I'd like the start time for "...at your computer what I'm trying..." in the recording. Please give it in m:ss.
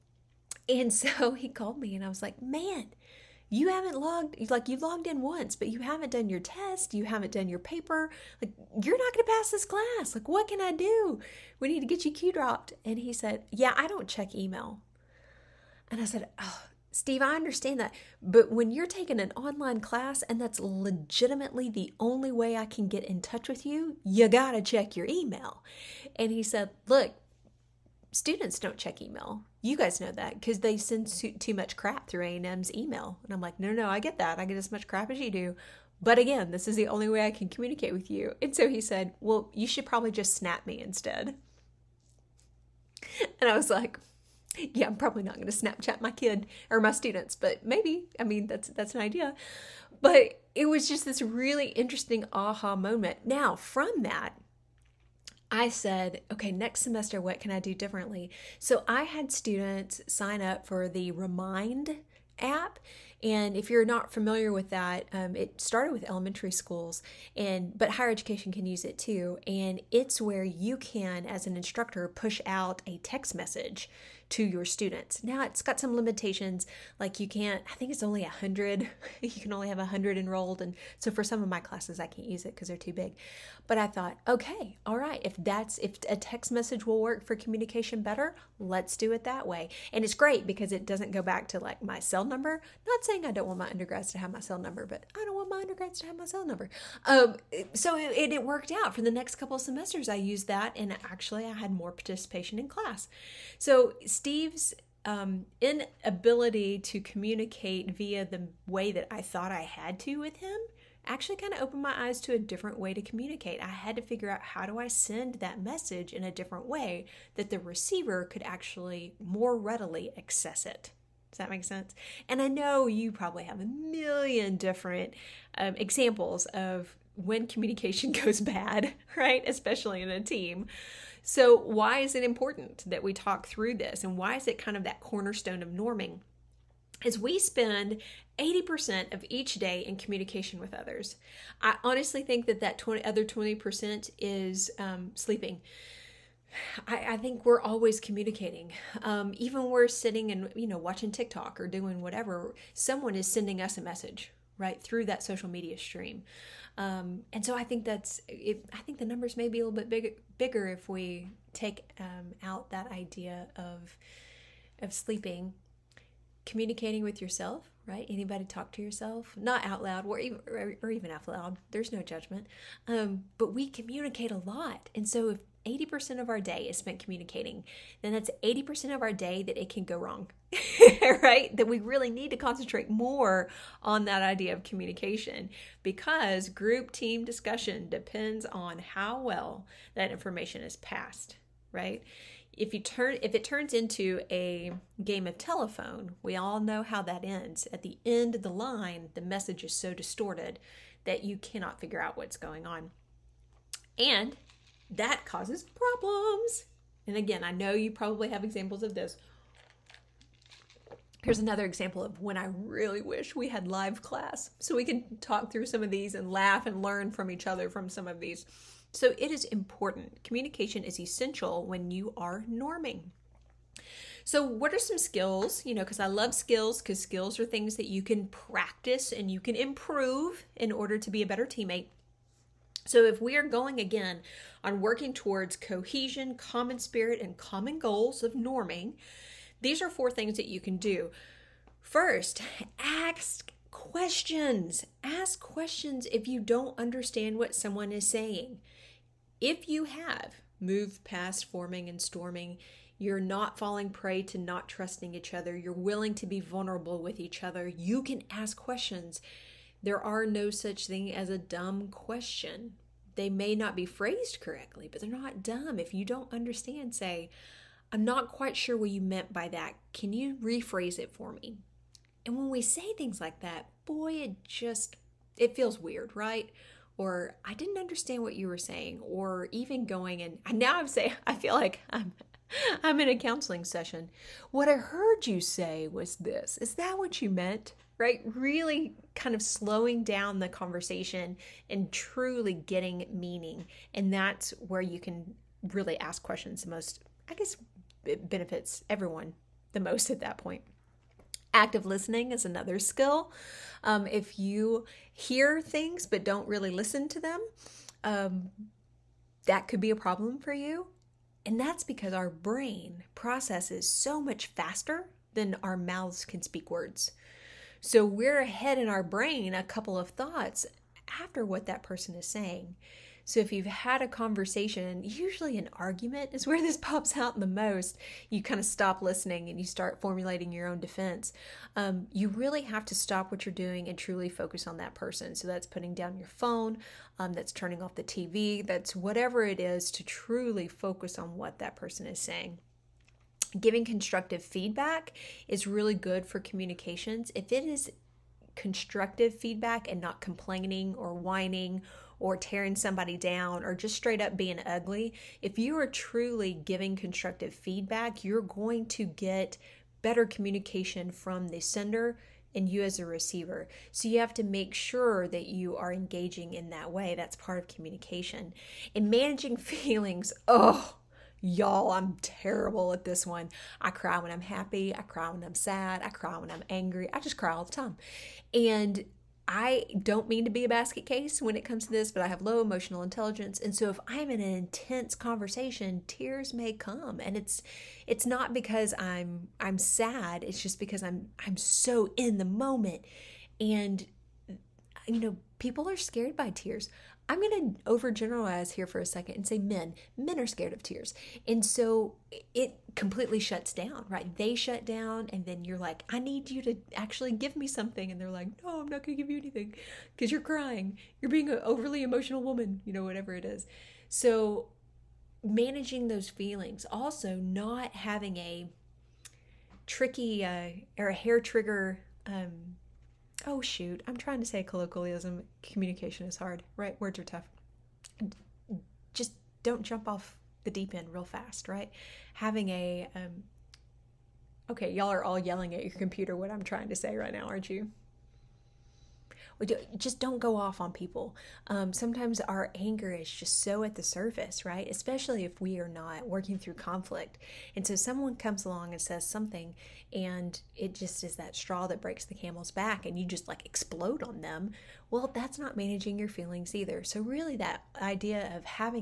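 7:15.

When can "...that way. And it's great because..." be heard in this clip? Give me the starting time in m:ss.
1:29.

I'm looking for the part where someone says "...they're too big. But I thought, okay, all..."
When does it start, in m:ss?
1:22.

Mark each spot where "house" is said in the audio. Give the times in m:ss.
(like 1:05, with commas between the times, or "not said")
not said.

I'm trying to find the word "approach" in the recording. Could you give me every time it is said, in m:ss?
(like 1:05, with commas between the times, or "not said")
not said.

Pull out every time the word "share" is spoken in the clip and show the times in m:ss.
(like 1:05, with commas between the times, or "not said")
not said.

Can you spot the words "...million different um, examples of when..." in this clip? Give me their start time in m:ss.
2:03.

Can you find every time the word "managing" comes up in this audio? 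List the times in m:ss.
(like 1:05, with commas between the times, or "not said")
6:09, 6:55, 7:35.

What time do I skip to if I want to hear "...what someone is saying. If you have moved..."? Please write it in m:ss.
4:07.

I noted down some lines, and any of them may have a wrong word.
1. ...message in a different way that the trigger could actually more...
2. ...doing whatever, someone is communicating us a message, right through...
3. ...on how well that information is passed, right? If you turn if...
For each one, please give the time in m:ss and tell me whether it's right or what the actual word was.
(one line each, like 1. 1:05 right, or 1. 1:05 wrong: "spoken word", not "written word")
1. 1:55 wrong: "receiver", not "trigger"
2. 2:31 wrong: "sending", not "communicating"
3. 3:08 right.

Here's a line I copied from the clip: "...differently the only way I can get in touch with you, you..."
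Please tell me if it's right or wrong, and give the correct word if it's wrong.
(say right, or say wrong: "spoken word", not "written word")
wrong: "legitimately", not "differently".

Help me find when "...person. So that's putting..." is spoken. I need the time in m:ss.
5:34.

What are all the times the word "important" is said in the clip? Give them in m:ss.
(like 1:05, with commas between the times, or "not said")
2:12, 3:39.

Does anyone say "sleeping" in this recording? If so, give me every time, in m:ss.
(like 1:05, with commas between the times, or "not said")
2:25, 2:44.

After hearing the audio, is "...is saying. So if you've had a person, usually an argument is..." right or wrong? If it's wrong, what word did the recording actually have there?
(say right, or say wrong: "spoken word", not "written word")
wrong: "conversation", not "person".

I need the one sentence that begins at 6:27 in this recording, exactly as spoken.
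And it's it's not because I'm I'm sad, it's just because I'm I'm so in the moment.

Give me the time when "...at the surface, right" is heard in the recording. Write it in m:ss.
7:23.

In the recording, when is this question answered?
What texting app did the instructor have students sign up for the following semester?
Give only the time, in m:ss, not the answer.
1:01.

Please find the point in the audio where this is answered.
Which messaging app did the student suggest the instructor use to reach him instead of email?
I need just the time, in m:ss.
0:45.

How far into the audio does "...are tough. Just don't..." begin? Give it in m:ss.
7:07.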